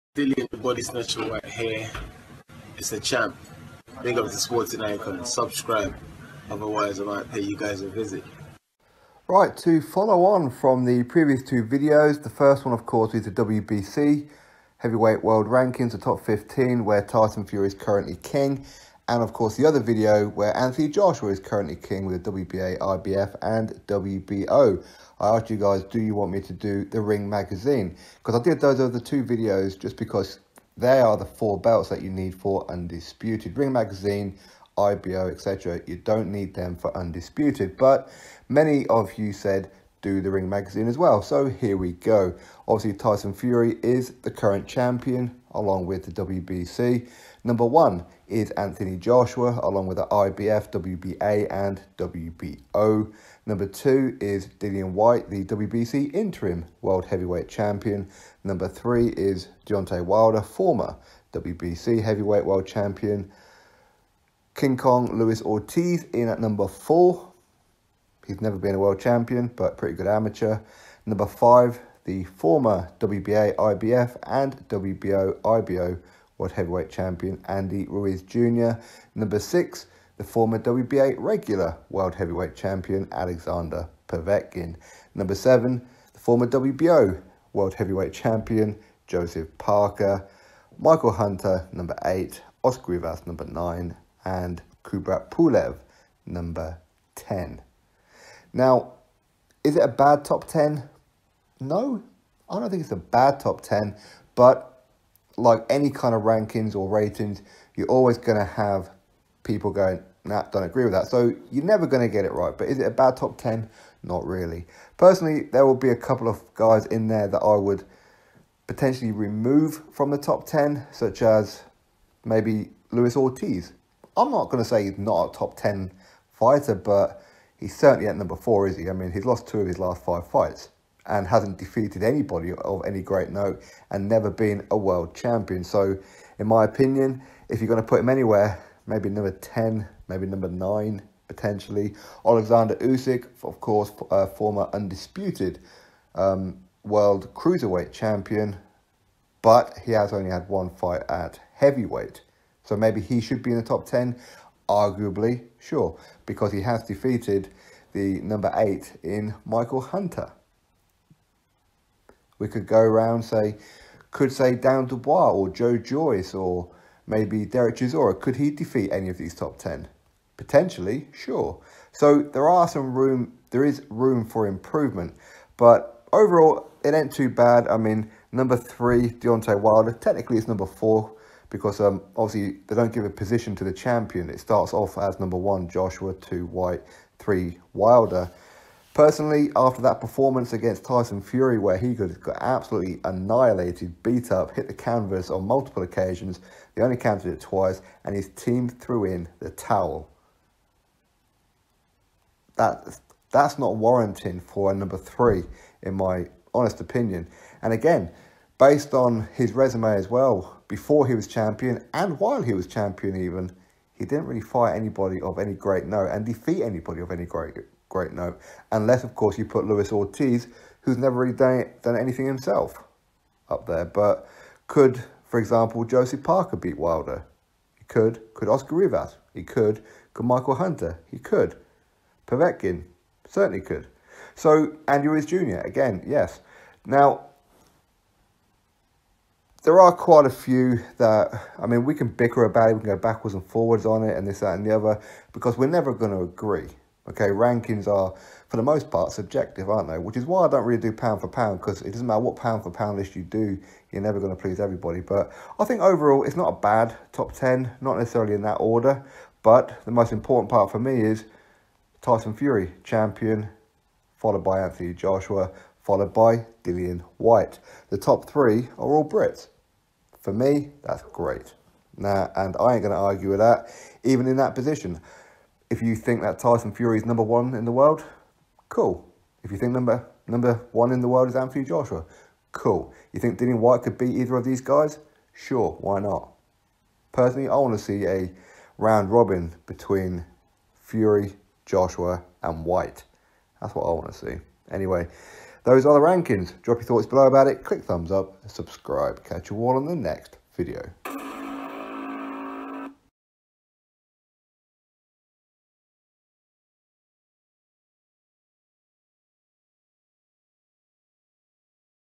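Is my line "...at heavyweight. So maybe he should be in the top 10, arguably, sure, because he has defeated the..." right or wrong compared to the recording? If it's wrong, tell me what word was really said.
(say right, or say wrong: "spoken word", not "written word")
right.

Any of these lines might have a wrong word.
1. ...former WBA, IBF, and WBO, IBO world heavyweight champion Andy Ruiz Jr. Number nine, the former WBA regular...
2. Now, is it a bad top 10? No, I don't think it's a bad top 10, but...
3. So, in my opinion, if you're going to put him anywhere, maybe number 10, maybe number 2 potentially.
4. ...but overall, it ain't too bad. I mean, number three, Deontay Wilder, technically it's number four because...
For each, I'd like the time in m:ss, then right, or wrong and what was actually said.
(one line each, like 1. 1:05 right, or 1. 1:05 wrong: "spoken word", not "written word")
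1. 1:12 wrong: "six", not "nine"
2. 1:38 right
3. 2:15 wrong: "9", not "2"
4. 2:55 right.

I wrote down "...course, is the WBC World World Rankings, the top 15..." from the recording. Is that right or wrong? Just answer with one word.
wrong.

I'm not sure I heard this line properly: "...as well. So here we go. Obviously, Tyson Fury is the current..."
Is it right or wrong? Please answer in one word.
right.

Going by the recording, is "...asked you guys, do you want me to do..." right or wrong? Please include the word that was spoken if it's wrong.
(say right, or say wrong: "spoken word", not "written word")
right.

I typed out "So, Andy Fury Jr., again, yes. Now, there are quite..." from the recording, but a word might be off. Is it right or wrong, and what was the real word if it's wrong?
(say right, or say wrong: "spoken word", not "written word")
wrong: "Ruiz", not "Fury".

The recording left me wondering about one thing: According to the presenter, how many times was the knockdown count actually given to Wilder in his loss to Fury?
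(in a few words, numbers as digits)
2.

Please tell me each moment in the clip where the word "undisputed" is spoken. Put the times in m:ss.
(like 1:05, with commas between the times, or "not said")
0:32, 0:36, 2:24.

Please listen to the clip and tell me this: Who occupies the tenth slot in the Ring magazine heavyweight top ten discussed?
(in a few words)
Kubrat Pulev.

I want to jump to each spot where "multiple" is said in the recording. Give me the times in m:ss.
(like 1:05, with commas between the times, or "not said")
3:15.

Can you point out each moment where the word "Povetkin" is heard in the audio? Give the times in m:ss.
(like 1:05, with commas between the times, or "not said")
1:24, 3:52.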